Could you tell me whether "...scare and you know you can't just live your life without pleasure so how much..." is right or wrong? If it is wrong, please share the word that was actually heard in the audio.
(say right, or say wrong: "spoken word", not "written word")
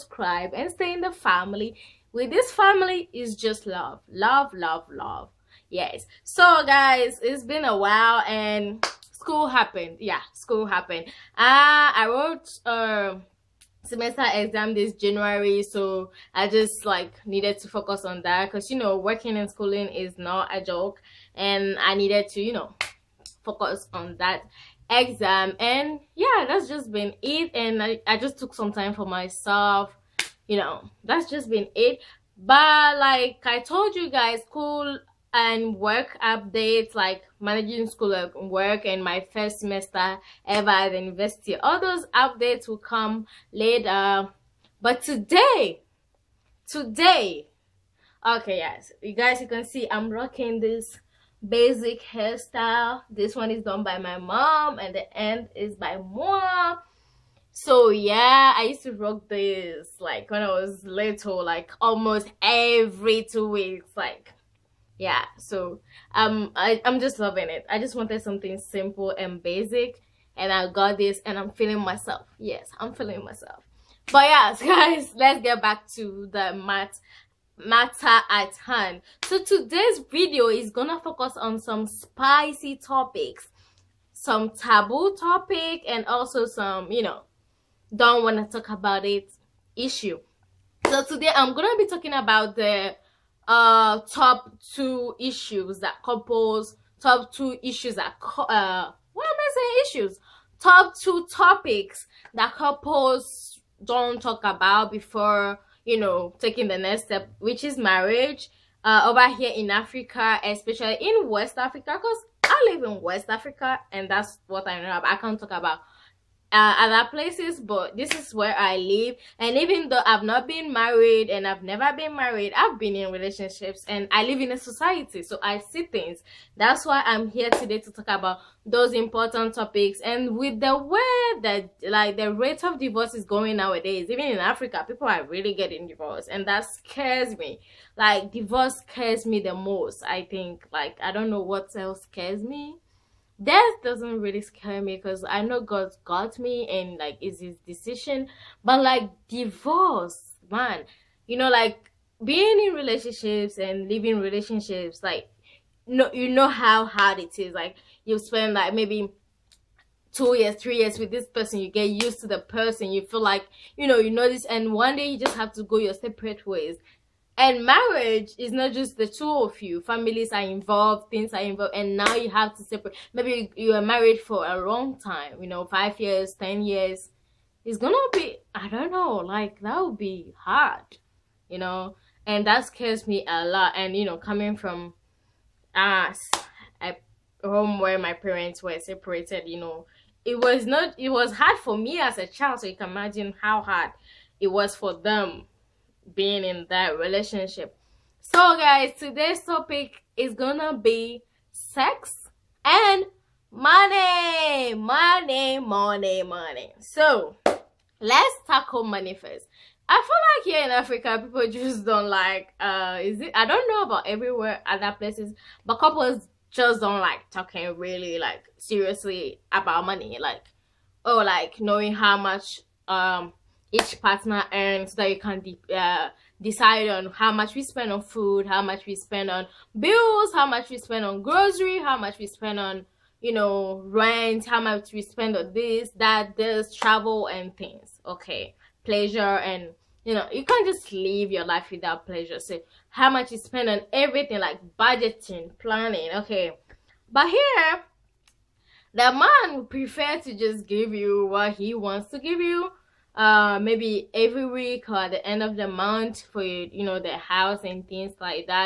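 wrong: "pleasure", not "scare".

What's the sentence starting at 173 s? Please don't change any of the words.
Maybe you are married for a long time, you know, five years, ten years.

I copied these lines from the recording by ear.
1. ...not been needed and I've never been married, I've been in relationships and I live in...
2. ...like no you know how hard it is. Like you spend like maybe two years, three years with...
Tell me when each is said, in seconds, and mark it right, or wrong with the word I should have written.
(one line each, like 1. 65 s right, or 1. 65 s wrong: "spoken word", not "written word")
1. 120 s wrong: "married", not "needed"
2. 155 s right.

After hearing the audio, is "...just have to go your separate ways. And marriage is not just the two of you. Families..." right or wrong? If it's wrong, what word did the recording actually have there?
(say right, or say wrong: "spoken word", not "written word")
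right.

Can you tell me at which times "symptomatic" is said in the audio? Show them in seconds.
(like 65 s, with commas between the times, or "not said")
not said.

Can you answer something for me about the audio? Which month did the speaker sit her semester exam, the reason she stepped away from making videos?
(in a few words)
January.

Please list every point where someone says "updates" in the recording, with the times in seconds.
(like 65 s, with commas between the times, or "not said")
36 s, 42 s.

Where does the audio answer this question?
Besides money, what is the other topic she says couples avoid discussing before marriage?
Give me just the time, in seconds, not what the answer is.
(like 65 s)
201 s.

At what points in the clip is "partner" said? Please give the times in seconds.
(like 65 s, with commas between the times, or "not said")
224 s.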